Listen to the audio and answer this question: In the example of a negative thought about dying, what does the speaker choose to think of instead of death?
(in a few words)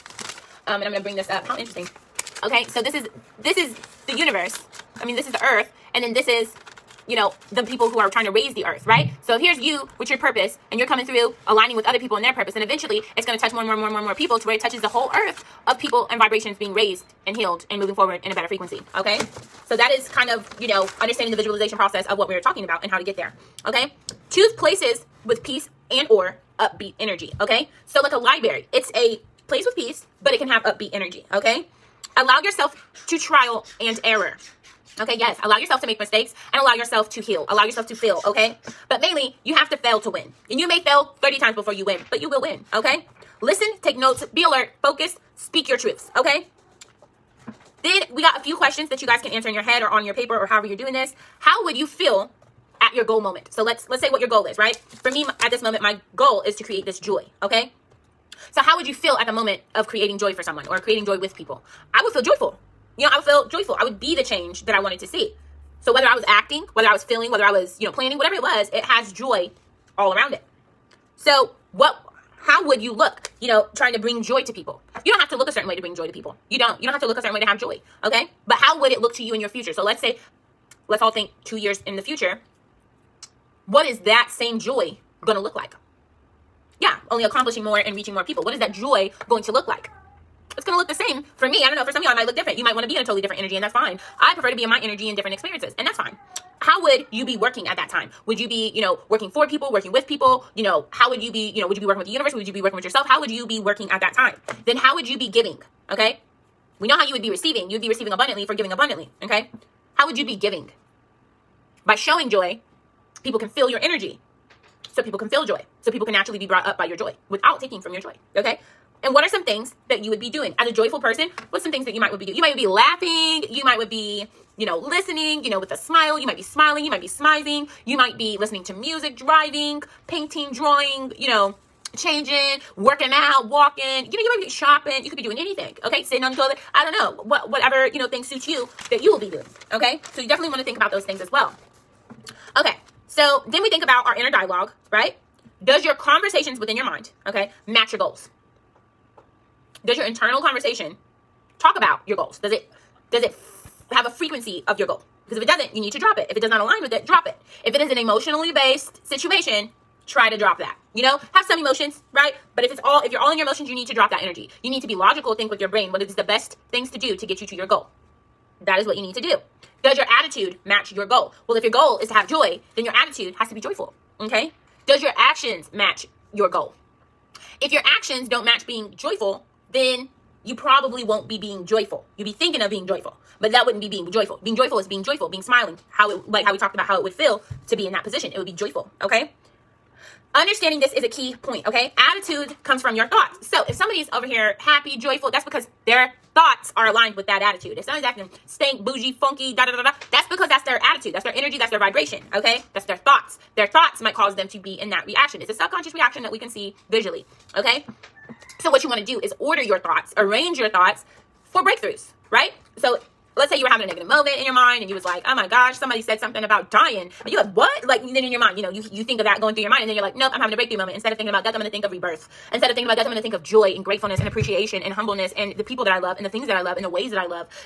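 rebirth.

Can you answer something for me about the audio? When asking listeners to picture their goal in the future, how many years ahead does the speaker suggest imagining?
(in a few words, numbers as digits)
2 years.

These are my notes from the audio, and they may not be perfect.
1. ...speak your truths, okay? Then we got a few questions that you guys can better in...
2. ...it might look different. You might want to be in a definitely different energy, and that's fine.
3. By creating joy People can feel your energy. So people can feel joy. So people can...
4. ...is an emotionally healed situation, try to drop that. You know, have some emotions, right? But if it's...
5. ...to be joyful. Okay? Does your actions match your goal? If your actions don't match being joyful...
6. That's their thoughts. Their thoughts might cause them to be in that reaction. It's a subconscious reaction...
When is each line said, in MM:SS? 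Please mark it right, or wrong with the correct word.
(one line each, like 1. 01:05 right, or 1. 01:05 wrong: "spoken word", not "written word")
1. 00:45 wrong: "answer", not "better"
2. 01:32 wrong: "totally", not "definitely"
3. 01:51 wrong: "showing", not "creating"
4. 02:37 wrong: "based", not "healed"
5. 02:53 right
6. 03:22 right.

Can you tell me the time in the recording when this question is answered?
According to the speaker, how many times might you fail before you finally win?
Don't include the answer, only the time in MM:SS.
00:41.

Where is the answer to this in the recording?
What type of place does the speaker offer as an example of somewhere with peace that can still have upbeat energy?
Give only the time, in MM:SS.
00:28.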